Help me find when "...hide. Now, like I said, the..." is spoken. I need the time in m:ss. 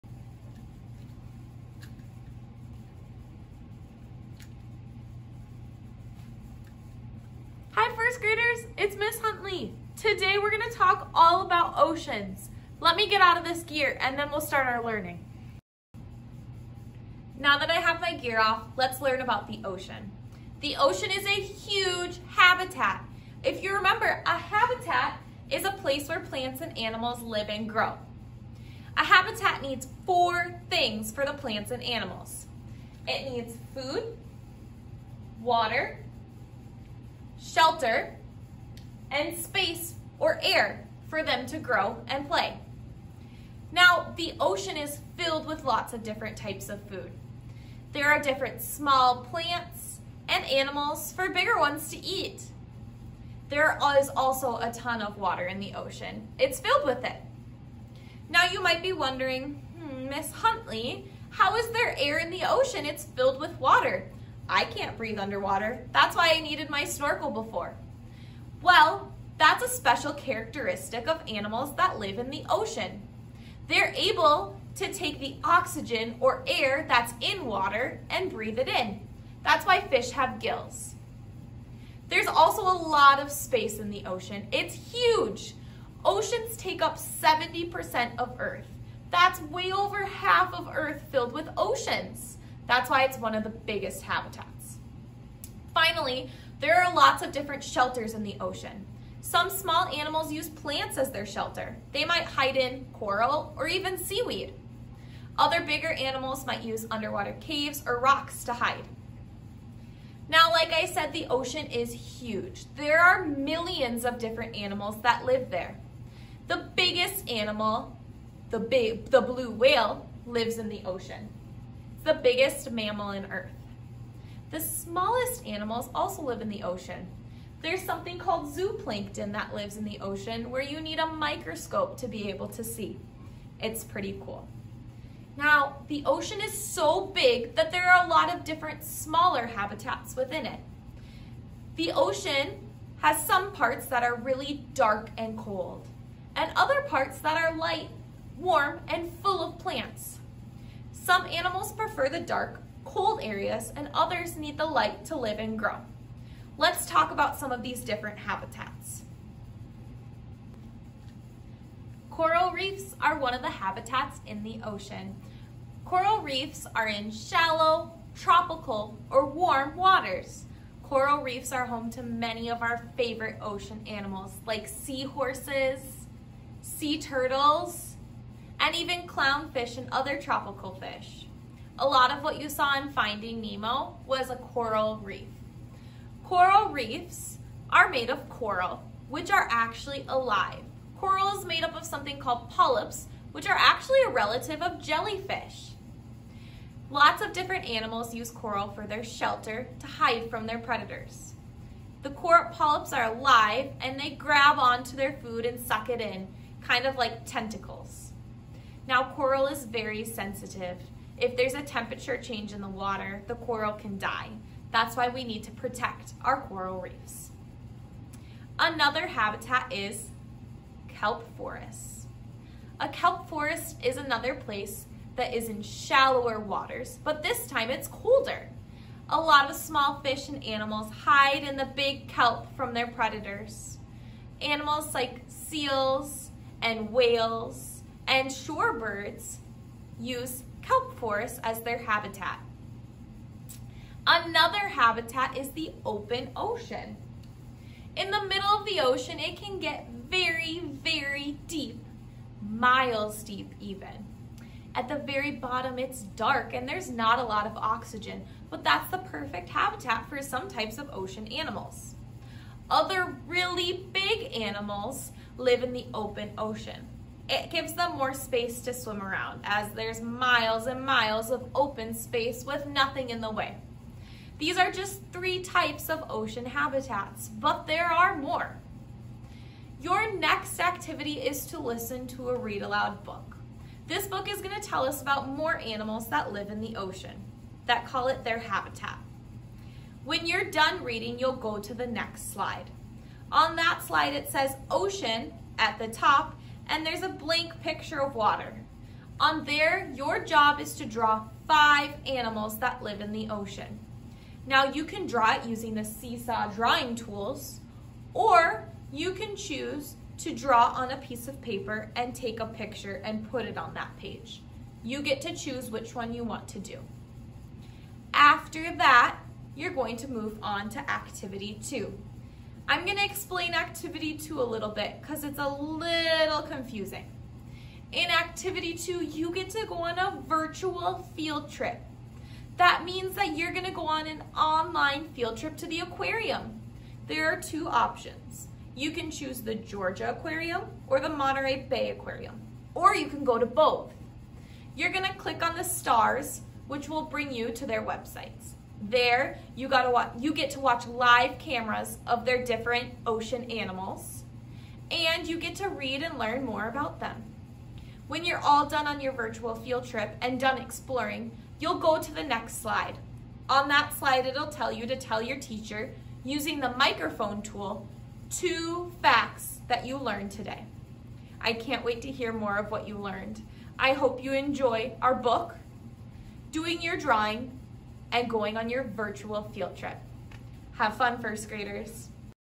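1:48.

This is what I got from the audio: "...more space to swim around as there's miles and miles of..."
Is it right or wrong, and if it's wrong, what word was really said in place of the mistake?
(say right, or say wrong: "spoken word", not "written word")
right.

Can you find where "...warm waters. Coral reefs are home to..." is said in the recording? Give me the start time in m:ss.
2:49.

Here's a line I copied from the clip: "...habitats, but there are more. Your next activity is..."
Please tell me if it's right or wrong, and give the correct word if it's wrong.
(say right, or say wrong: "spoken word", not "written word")
right.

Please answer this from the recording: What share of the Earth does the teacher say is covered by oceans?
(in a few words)
70%.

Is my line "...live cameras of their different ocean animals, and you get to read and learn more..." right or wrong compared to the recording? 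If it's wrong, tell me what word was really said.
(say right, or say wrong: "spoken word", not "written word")
right.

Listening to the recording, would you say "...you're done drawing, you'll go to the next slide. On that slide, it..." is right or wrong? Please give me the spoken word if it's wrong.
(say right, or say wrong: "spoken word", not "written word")
wrong: "reading", not "drawing".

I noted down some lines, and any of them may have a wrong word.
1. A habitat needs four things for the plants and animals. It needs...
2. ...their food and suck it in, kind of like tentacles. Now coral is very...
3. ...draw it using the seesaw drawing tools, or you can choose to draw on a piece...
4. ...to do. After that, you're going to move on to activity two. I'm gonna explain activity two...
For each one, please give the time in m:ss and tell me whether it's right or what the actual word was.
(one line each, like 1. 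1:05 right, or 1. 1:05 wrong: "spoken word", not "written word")
1. 0:28 right
2. 3:24 right
3. 5:05 right
4. 5:16 right.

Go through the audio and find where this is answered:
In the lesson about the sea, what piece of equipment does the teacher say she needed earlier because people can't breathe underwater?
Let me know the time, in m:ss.
1:06.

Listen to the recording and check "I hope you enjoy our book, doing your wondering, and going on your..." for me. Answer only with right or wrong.
wrong.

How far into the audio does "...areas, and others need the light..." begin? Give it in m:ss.
2:33.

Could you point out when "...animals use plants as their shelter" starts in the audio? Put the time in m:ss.
1:39.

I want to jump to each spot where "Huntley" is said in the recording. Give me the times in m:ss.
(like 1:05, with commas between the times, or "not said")
0:09, 1:00.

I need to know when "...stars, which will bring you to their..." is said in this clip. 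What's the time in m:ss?
5:45.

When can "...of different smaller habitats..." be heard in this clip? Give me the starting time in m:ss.
2:18.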